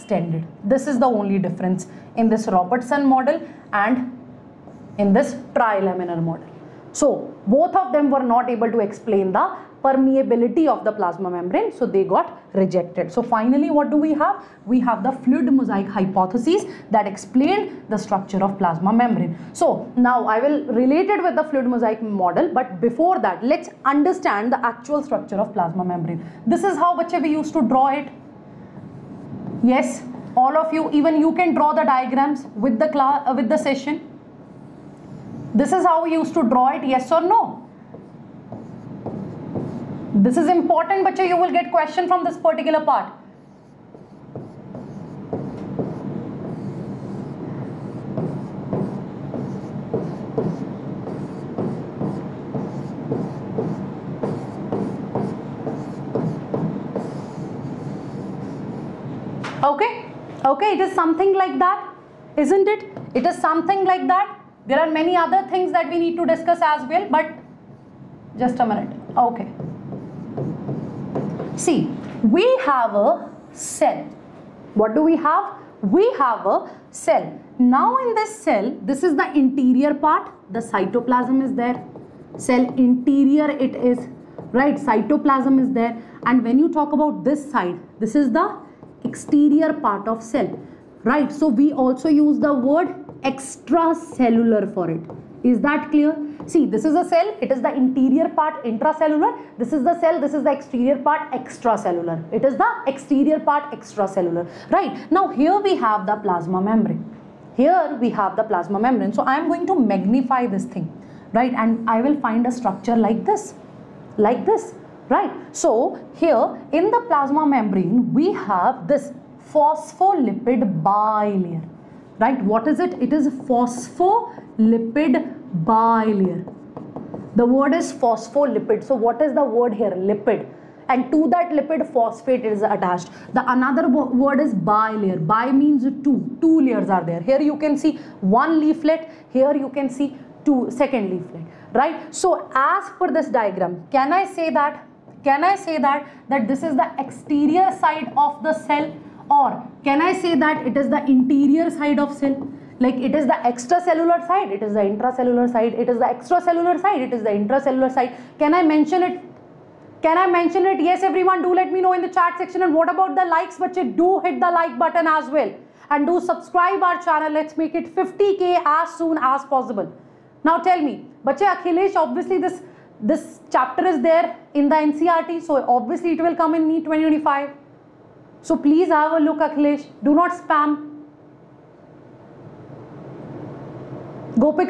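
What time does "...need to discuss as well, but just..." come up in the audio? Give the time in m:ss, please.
1:06.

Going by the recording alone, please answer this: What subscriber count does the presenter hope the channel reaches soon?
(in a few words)
50k.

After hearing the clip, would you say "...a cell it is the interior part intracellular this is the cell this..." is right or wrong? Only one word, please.
right.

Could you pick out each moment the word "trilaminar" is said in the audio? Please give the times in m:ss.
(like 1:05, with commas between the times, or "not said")
0:05.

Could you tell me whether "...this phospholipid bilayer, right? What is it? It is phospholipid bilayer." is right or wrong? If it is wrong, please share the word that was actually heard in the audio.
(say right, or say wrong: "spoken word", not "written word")
right.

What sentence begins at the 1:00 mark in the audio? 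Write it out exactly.
Okay, it is something like that, isn't it?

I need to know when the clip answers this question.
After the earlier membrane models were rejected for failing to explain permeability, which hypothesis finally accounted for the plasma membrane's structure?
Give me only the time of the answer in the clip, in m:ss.
0:15.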